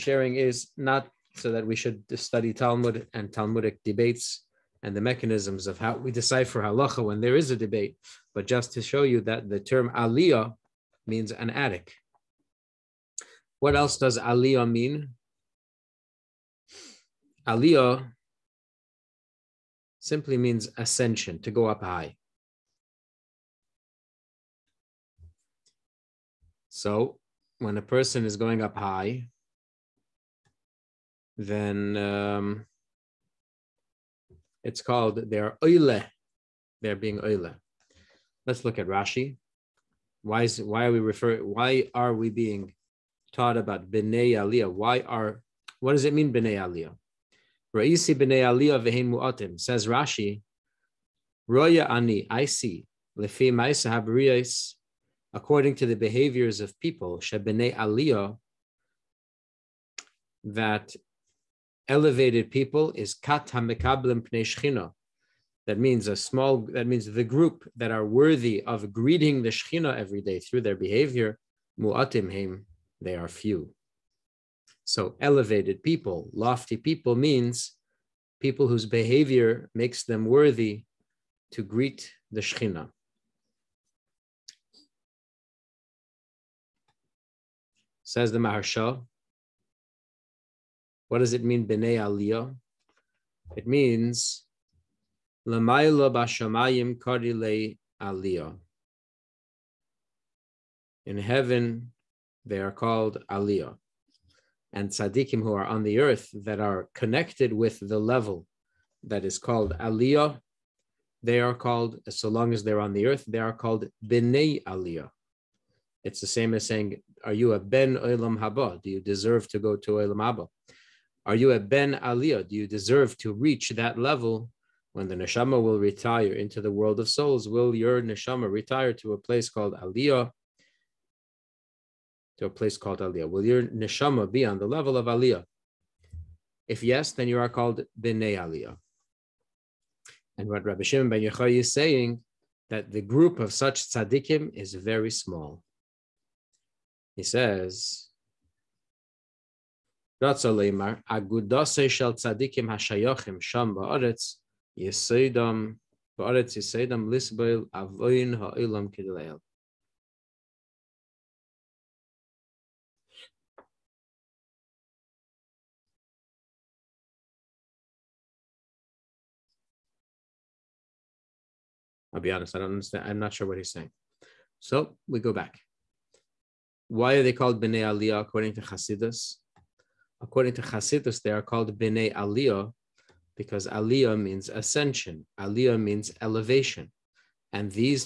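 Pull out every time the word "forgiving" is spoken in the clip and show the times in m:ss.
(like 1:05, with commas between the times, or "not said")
not said.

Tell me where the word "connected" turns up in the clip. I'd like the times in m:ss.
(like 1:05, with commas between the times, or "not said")
1:46.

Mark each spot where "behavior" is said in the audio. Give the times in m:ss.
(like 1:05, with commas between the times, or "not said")
0:55, 1:10, 1:18.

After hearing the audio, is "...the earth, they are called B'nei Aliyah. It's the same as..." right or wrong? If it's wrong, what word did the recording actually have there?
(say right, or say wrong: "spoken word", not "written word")
right.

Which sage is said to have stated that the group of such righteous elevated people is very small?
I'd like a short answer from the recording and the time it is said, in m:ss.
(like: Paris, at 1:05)
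Rabbi Shimon ben Yochai, at 2:20.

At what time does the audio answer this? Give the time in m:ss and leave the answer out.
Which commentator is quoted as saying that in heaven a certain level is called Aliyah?
1:28.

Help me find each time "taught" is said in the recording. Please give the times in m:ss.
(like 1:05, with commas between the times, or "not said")
0:43.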